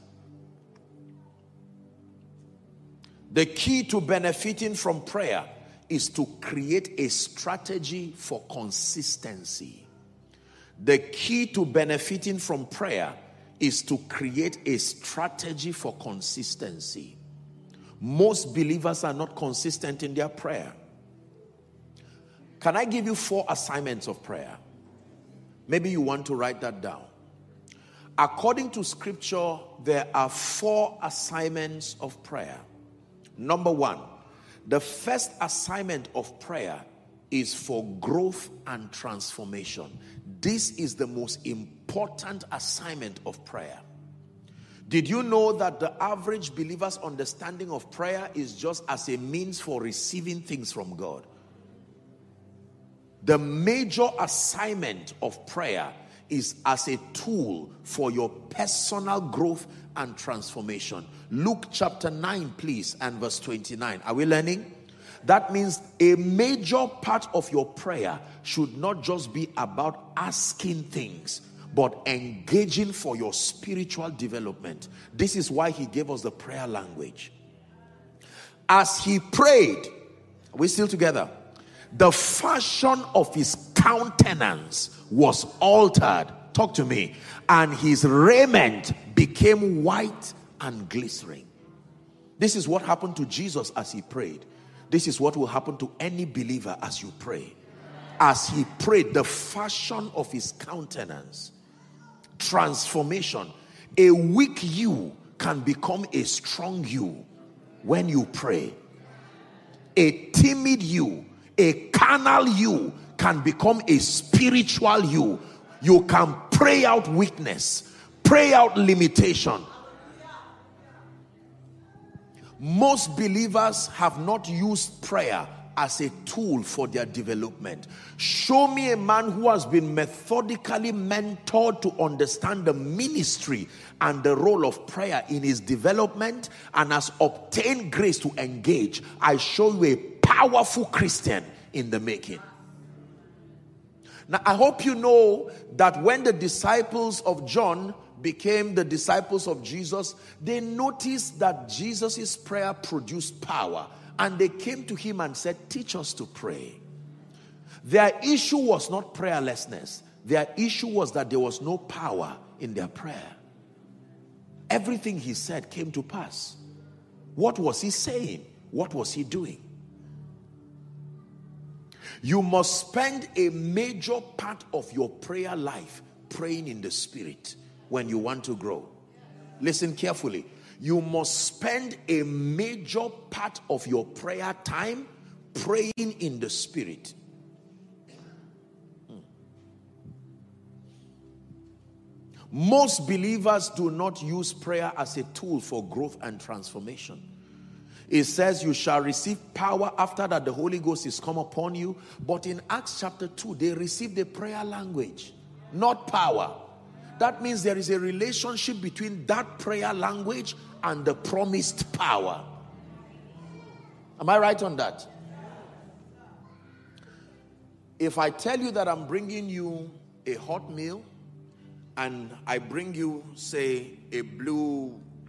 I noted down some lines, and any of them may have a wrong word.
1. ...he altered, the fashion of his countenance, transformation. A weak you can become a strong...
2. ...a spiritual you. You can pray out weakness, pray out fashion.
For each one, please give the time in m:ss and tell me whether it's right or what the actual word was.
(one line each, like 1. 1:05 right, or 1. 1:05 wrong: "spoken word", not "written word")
1. 1:38 wrong: "prayed", not "altered"
2. 1:53 wrong: "limitation", not "fashion".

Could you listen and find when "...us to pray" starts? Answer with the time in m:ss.
2:35.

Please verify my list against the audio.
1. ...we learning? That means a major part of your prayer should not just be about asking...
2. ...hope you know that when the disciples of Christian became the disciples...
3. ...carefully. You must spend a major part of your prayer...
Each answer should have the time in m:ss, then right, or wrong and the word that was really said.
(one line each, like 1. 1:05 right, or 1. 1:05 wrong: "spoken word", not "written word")
1. 1:04 right
2. 2:24 wrong: "John", not "Christian"
3. 2:59 right.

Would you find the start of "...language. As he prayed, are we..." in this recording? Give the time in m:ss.
1:16.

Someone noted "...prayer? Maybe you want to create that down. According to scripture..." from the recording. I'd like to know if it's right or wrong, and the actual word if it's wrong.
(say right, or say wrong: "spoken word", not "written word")
wrong: "write", not "create".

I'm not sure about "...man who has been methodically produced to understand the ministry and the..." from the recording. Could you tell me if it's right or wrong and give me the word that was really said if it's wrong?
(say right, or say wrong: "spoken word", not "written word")
wrong: "mentored", not "produced".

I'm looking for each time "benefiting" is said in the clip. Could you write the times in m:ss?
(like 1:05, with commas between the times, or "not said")
0:04, 0:11.